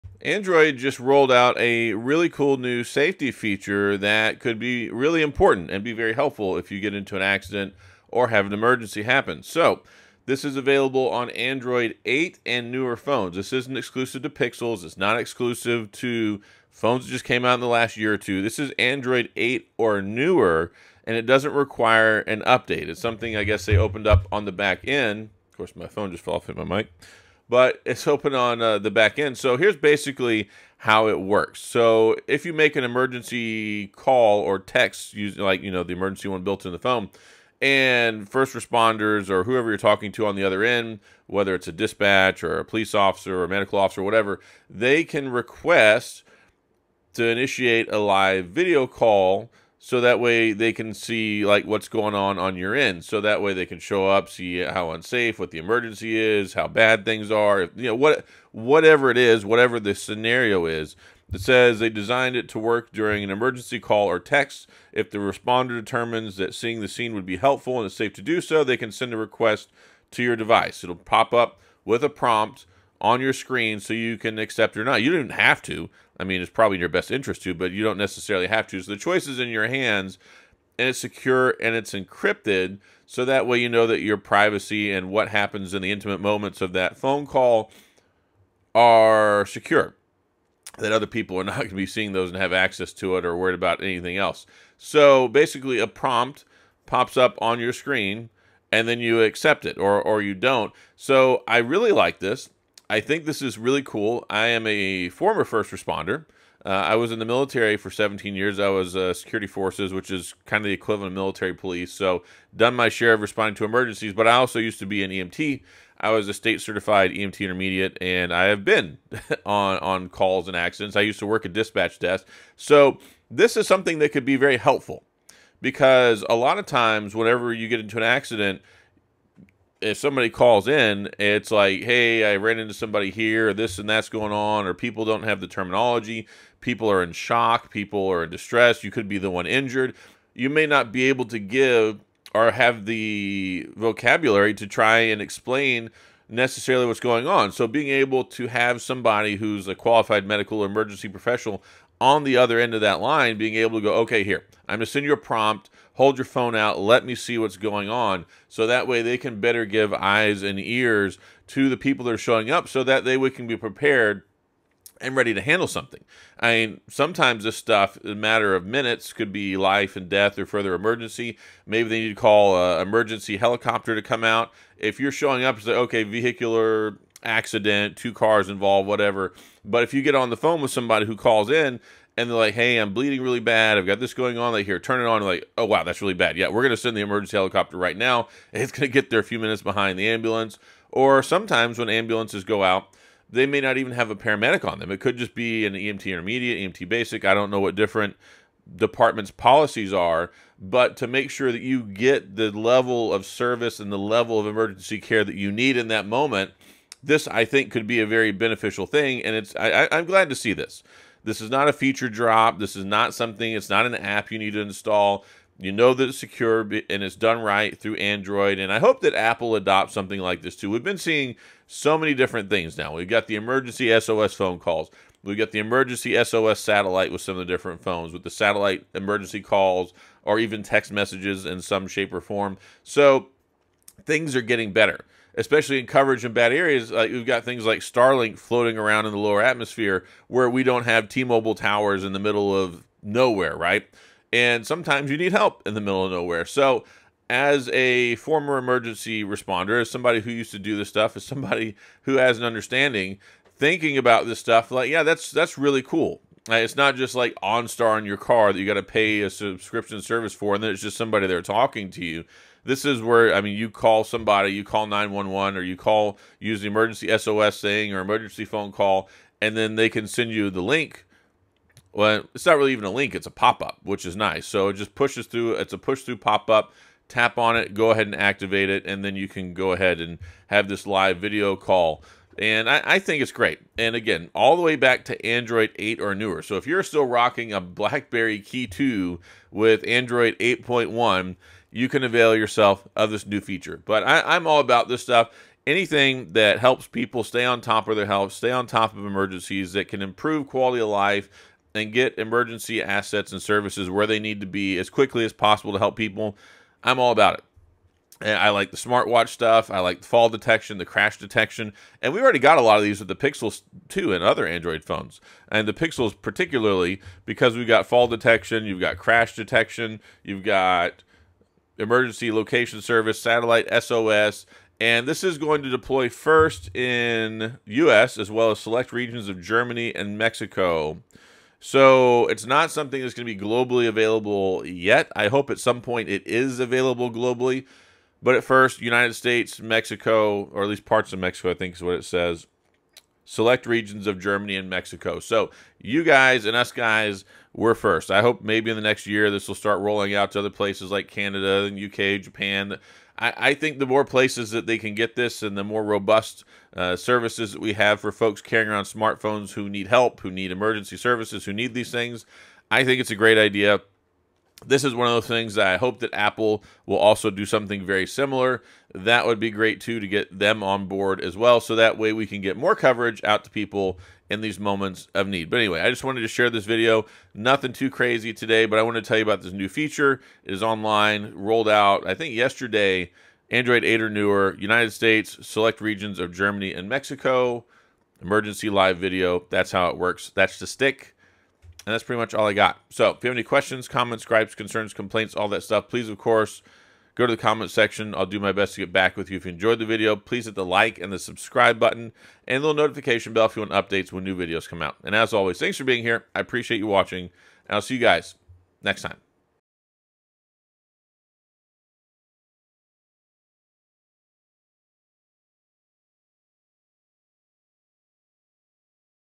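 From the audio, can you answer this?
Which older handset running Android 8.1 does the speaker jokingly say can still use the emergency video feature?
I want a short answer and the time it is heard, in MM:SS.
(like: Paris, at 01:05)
BlackBerry Key2, at 04:47.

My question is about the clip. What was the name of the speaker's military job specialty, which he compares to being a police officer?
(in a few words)
Security forces.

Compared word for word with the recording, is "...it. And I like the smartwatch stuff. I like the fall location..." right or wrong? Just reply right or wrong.
wrong.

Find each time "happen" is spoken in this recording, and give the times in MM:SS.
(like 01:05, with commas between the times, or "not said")
00:09, 01:25.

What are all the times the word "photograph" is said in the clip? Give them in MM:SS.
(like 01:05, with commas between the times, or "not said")
not said.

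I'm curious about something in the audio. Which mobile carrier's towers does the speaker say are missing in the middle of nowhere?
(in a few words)
T-Mobile.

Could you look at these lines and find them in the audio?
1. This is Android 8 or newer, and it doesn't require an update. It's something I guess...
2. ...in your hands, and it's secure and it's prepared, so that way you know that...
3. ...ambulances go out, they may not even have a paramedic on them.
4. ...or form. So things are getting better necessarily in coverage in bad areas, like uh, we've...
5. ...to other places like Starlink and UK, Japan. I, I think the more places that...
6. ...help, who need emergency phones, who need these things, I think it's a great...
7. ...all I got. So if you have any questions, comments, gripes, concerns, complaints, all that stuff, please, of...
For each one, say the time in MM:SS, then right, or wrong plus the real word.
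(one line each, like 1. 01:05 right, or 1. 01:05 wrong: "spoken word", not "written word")
1. 00:18 right
2. 01:19 wrong: "encrypted", not "prepared"
3. 03:11 right
4. 03:52 wrong: "especially", not "necessarily"
5. 05:50 wrong: "Canada", not "Starlink"
6. 05:59 wrong: "services", not "phones"
7. 06:32 right.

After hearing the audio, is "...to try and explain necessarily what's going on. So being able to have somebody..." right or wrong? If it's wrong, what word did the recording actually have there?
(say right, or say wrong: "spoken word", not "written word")
right.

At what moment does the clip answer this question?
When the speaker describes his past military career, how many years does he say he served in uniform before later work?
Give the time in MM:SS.
01:47.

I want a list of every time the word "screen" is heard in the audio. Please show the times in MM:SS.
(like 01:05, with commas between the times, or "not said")
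01:13, 01:37.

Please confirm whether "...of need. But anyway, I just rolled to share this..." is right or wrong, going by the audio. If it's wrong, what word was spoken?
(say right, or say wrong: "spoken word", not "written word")
wrong: "wanted", not "rolled".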